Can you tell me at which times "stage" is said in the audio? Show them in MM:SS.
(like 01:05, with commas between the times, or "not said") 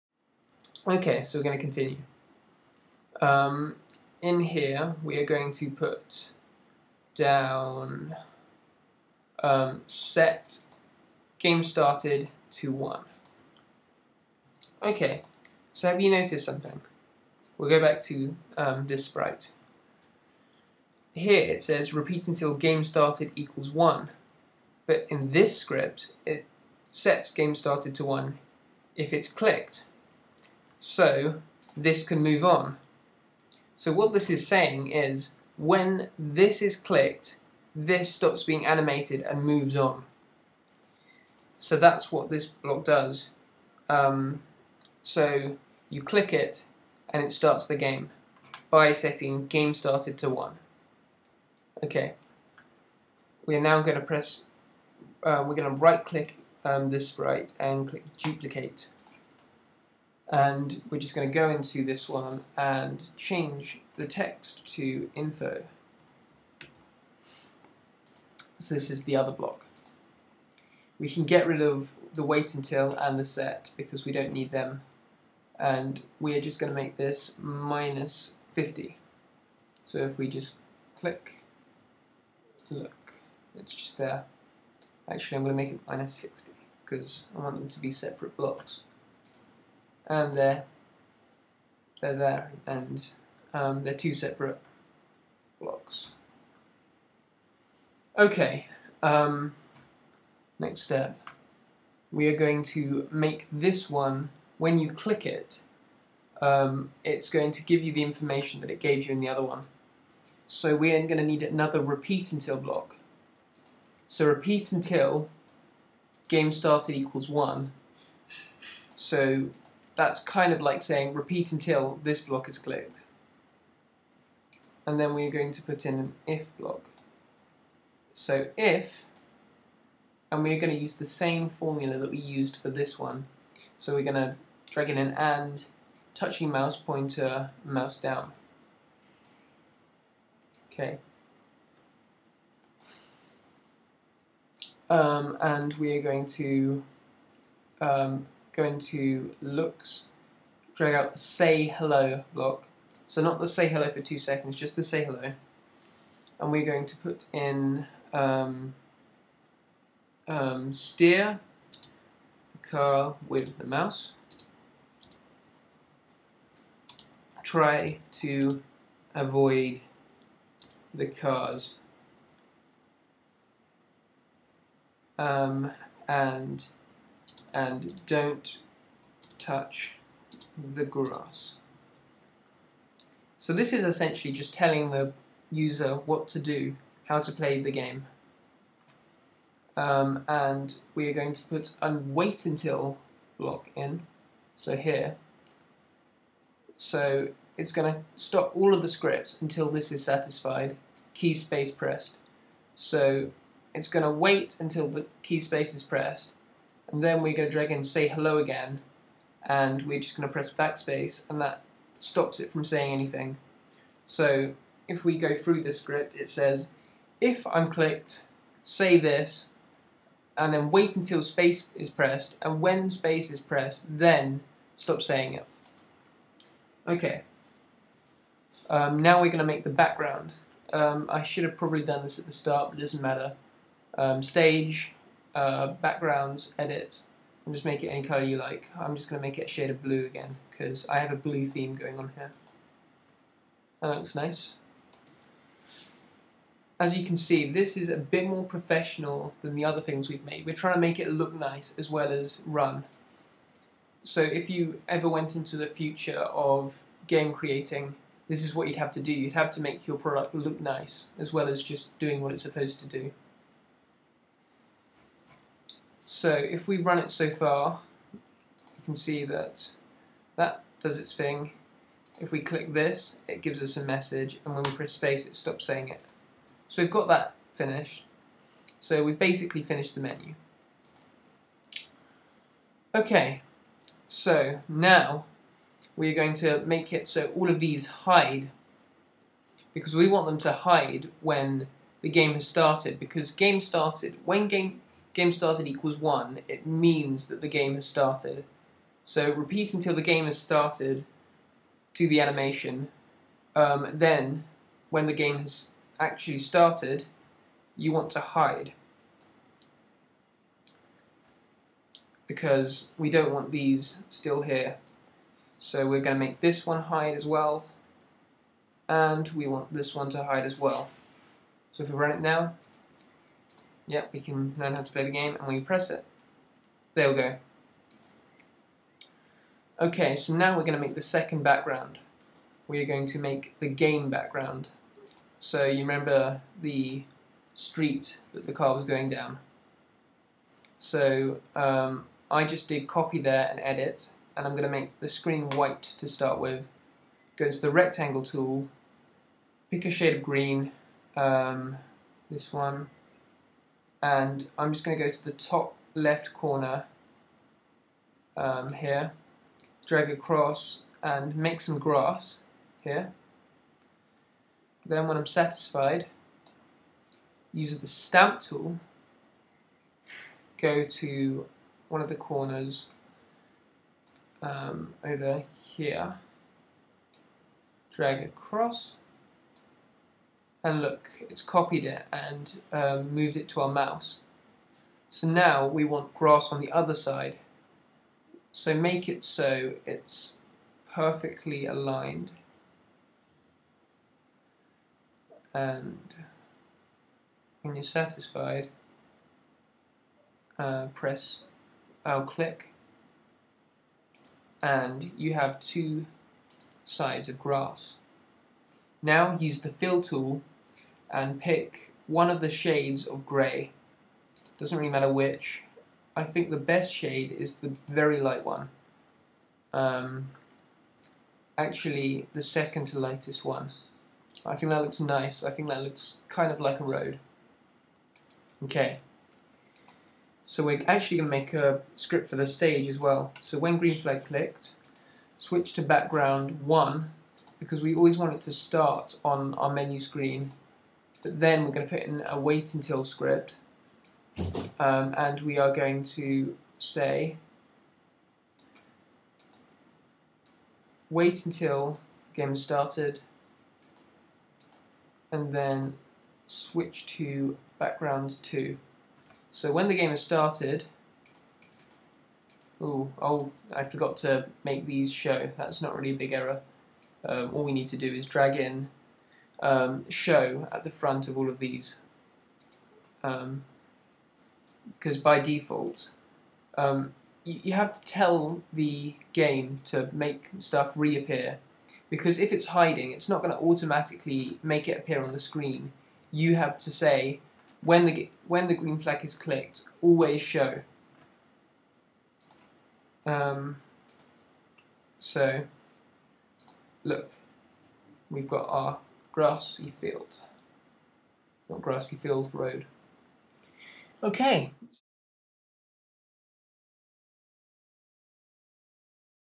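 03:54, 07:12.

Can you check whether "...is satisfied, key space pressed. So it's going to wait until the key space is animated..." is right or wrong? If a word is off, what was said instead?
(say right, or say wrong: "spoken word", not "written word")
wrong: "pressed", not "animated".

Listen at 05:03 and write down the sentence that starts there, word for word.
Um, then, when the game has actually started, you want to hide.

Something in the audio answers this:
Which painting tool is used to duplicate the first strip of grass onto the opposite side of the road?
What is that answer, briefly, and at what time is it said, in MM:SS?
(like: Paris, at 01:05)
stamp tool, at 06:07.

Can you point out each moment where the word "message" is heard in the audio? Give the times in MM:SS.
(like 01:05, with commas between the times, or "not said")
04:33.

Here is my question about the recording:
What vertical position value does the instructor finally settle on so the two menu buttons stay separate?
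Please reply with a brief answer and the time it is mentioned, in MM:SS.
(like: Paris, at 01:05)
-60, at 01:25.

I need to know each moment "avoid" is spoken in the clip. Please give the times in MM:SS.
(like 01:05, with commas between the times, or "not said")
02:49.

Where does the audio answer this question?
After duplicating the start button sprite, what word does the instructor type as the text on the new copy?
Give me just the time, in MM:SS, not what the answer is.
01:05.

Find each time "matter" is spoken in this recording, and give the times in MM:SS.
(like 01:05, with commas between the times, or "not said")
03:53, 06:54.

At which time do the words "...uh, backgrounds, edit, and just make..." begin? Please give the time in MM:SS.
03:55.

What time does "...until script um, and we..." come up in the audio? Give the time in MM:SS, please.
07:22.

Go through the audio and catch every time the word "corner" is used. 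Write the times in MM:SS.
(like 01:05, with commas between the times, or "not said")
05:56, 06:12.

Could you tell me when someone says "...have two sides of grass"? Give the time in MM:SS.
06:45.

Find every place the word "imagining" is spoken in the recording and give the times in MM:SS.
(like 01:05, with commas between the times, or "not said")
not said.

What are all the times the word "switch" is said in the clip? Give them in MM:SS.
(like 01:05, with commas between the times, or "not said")
07:15, 07:36.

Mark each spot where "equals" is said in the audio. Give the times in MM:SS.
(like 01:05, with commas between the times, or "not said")
00:23, 01:56, 04:55.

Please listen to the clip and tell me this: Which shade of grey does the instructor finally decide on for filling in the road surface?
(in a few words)
second to lightest.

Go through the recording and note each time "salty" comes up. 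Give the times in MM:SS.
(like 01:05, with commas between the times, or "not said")
not said.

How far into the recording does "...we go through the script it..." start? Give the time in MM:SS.
03:35.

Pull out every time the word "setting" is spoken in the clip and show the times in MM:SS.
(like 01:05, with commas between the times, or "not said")
00:48.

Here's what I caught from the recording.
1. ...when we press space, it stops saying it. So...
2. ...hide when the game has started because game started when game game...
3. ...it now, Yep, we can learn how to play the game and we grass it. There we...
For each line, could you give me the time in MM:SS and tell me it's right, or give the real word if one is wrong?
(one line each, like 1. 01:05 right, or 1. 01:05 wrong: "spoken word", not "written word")
1. 04:34 right
2. 04:50 right
3. 05:22 wrong: "press", not "grass".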